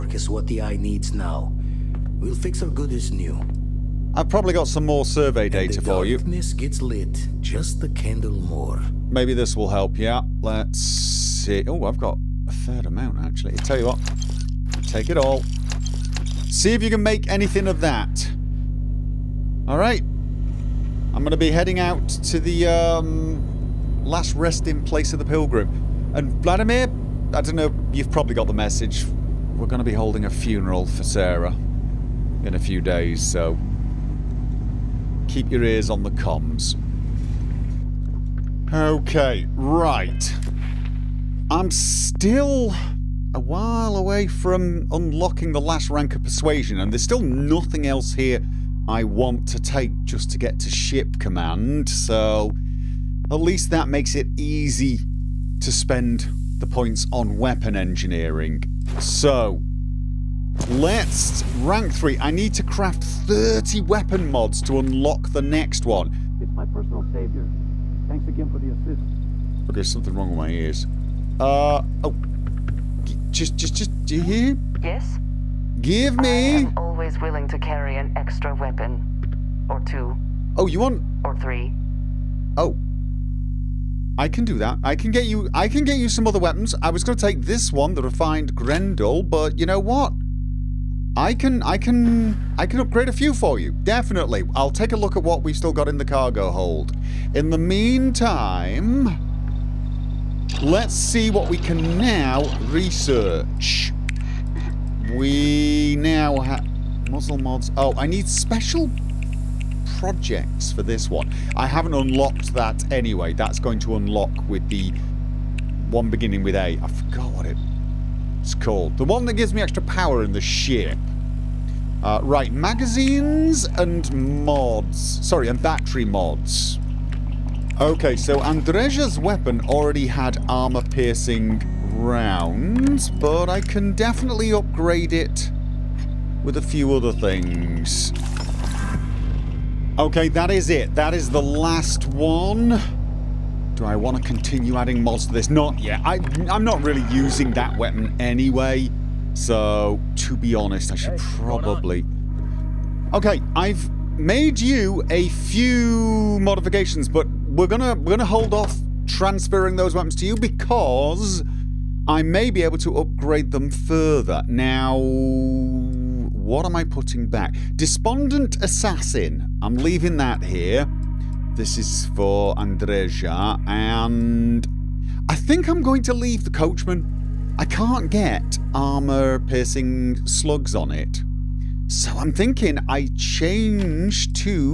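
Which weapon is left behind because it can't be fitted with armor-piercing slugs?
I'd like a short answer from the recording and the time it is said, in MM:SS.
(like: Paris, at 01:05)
the Coachman, at 02:56.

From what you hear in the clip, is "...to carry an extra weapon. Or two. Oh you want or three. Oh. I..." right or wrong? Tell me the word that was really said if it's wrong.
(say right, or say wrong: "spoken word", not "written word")
right.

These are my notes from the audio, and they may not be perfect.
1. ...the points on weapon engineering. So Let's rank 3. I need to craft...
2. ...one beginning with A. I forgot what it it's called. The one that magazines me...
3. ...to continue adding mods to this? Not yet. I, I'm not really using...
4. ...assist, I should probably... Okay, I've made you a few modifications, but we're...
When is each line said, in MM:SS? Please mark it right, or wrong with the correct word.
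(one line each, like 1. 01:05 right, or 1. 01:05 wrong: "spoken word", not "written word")
1. 00:56 right
2. 01:55 wrong: "gives", not "magazines"
3. 02:24 right
4. 02:30 wrong: "honest", not "assist".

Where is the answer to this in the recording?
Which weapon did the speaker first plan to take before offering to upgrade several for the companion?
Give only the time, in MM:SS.
01:28.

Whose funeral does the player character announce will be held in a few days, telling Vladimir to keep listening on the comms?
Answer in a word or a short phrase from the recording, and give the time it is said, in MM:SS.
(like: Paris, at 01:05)
Sarah, at 00:31.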